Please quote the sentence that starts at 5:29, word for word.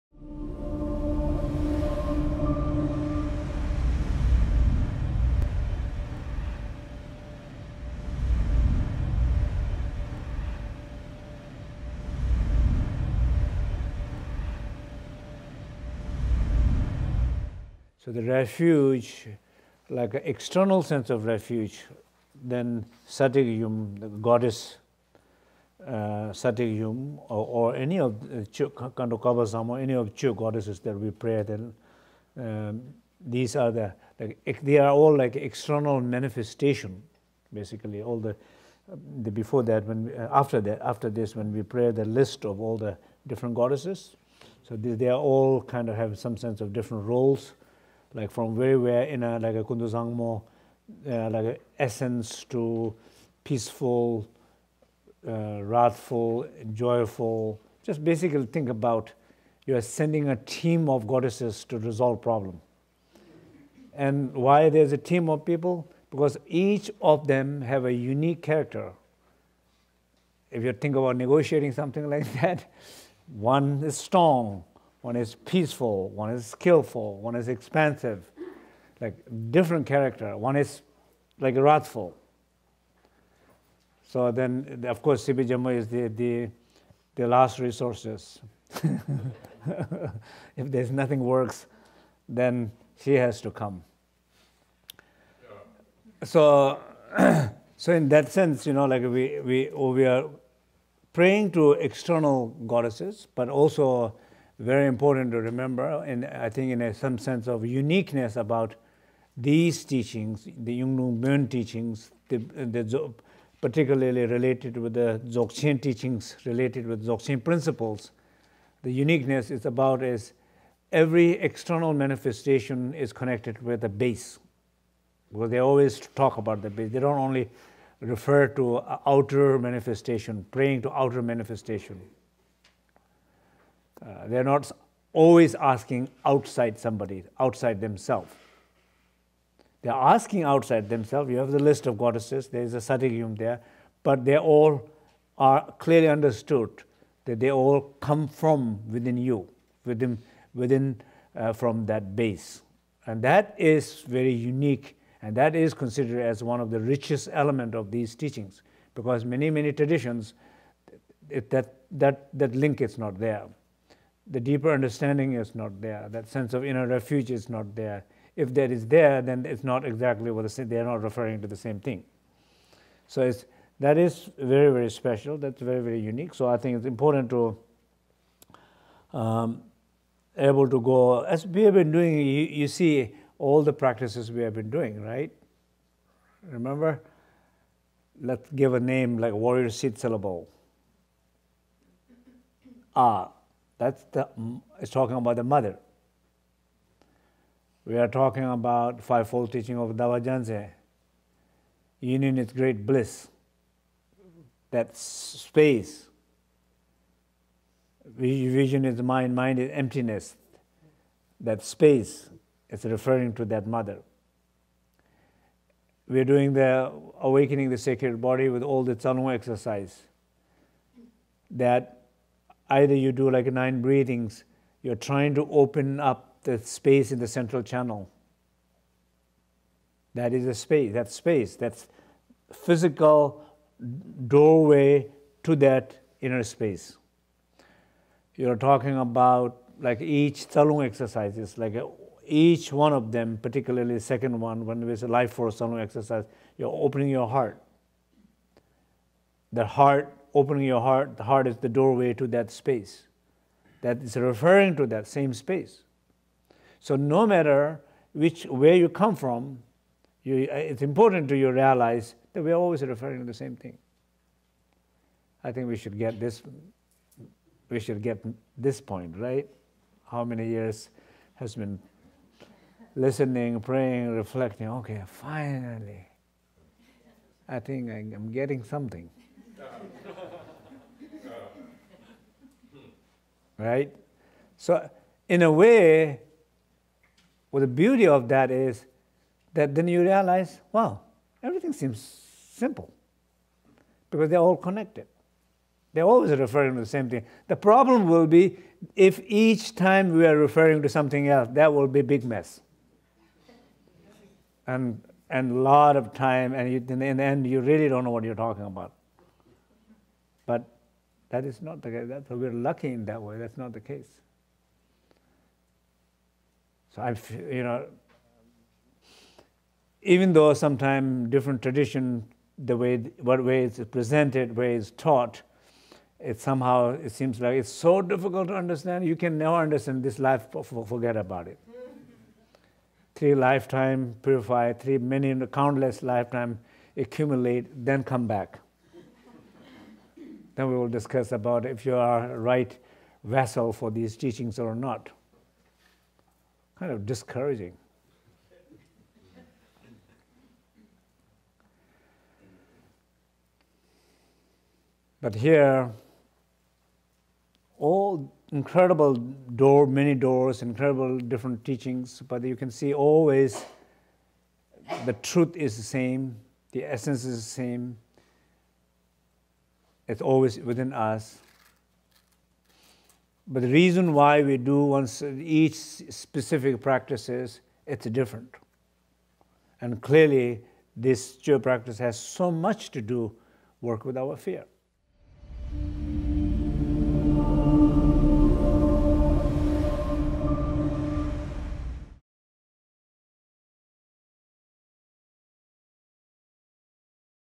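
You can never understand this life.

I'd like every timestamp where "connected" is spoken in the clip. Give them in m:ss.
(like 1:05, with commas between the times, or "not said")
2:03, 4:54.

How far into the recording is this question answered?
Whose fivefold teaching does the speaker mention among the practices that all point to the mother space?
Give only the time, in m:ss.
3:19.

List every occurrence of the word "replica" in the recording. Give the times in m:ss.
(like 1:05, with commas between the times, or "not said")
not said.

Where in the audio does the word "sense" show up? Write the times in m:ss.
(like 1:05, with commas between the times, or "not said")
0:20, 0:46, 1:38, 1:47, 2:46.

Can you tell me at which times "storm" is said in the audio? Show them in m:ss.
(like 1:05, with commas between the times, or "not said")
not said.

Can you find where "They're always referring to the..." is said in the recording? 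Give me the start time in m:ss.
4:55.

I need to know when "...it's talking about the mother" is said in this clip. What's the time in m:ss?
3:14.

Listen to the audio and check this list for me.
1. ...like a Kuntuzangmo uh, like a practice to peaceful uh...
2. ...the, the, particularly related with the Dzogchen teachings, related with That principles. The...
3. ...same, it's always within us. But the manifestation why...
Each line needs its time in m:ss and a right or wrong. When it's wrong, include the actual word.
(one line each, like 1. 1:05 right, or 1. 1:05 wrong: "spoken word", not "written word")
1. 0:49 wrong: "essence", not "practice"
2. 1:52 wrong: "Dzogchen", not "That"
3. 6:07 wrong: "reason", not "manifestation".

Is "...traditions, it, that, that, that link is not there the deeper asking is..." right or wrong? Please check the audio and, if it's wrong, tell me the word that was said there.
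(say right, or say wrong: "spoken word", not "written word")
wrong: "understanding", not "asking".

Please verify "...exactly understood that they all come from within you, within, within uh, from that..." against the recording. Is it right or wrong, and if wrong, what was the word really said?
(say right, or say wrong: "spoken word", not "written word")
wrong: "clearly", not "exactly".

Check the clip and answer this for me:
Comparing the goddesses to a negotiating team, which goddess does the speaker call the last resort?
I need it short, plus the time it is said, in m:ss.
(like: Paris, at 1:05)
Sibi Jammu, at 1:25.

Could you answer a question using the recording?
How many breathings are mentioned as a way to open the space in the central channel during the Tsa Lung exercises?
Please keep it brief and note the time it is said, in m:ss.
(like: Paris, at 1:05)
9, at 3:43.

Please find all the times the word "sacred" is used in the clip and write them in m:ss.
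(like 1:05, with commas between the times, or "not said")
3:37.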